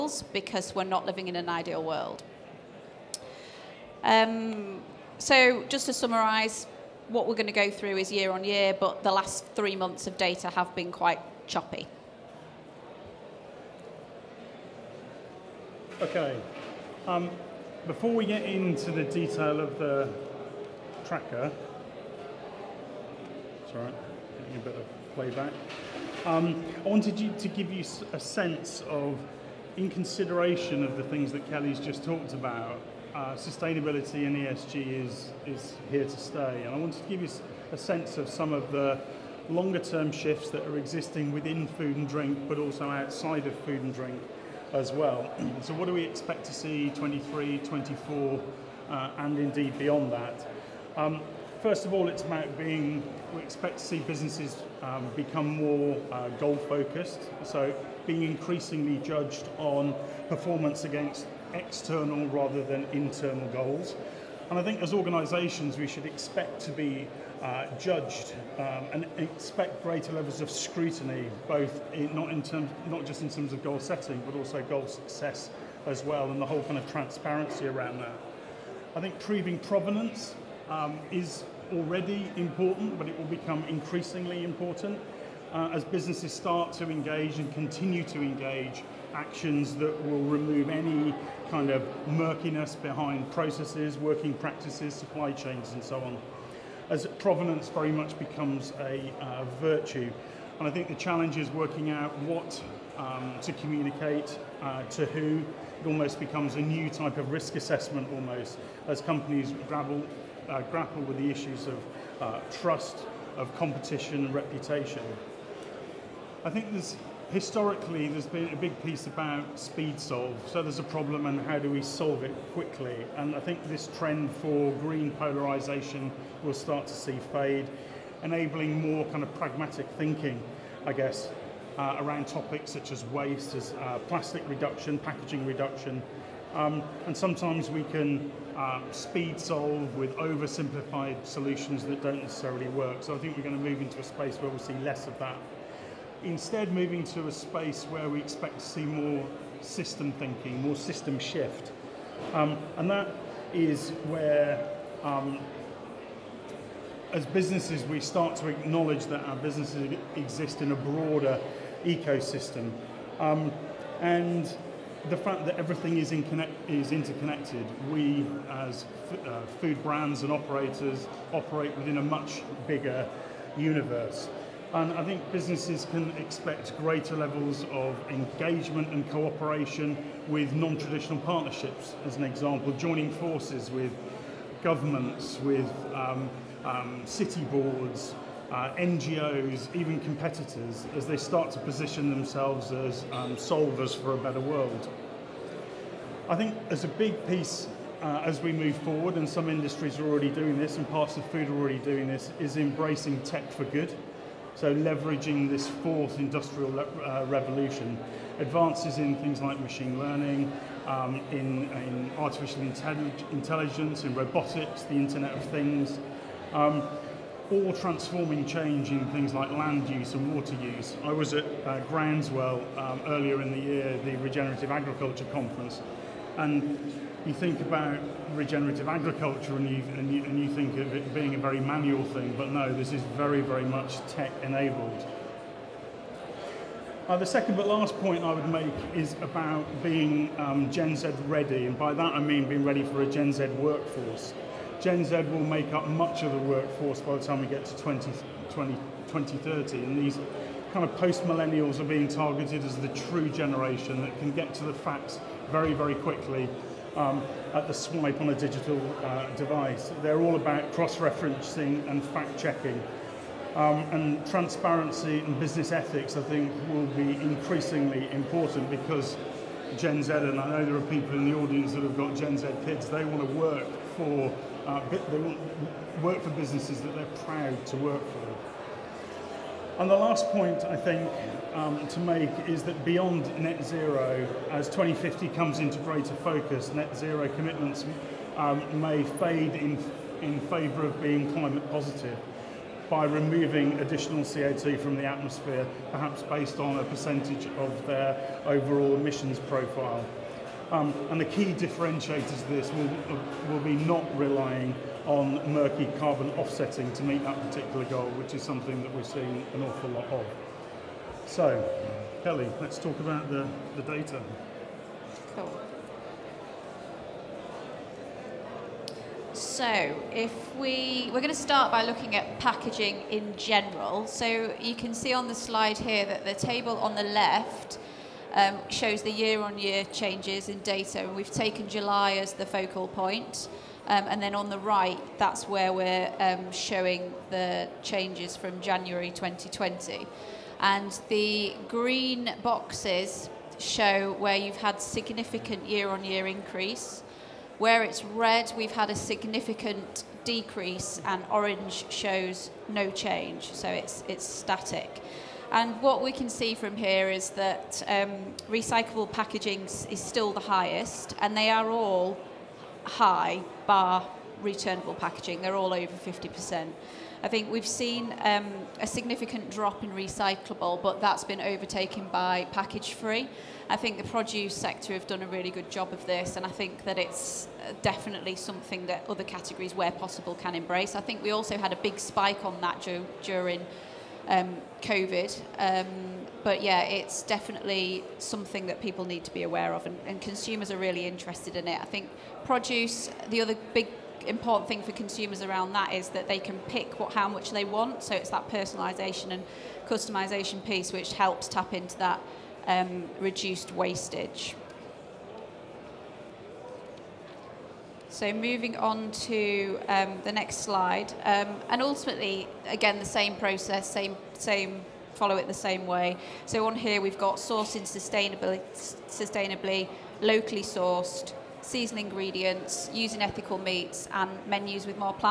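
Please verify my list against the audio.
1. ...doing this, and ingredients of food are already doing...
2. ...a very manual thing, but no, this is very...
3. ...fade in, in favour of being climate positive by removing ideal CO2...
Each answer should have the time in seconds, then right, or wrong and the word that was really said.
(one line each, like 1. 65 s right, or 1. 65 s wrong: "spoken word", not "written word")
1. 200 s wrong: "parts", not "ingredients"
2. 231 s right
3. 289 s wrong: "additional", not "ideal".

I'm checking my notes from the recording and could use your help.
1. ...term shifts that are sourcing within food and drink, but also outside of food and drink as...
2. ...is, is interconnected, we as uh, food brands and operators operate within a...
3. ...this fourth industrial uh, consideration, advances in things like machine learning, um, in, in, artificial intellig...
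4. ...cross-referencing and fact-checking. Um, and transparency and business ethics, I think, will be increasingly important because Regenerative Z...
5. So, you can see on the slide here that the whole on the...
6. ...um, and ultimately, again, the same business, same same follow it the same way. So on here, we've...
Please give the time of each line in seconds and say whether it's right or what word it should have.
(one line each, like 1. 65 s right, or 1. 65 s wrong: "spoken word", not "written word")
1. 39 s wrong: "existing", not "sourcing"
2. 165 s right
3. 205 s wrong: "revolution", not "consideration"
4. 260 s wrong: "Gen", not "Regenerative"
5. 324 s wrong: "table", not "whole"
6. 411 s wrong: "process", not "business".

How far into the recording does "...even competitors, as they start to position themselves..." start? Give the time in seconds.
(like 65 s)
189 s.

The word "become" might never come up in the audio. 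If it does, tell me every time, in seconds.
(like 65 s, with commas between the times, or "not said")
55 s, 83 s, 98 s, 106 s.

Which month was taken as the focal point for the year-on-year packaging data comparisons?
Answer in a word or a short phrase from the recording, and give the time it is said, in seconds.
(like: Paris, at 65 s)
July, at 331 s.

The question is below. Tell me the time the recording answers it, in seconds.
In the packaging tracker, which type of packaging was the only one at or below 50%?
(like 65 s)
364 s.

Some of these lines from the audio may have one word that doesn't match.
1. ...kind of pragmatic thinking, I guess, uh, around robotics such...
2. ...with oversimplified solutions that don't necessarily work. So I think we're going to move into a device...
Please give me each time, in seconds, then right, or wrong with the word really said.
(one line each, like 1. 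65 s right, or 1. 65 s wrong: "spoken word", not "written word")
1. 129 s wrong: "topics", not "robotics"
2. 139 s wrong: "space", not "device".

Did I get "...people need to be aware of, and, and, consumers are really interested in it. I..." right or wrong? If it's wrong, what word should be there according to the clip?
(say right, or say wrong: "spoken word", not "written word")
right.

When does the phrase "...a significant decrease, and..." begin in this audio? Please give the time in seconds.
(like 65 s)
348 s.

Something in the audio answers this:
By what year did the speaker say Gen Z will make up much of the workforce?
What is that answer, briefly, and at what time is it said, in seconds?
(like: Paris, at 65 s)
2030, at 249 s.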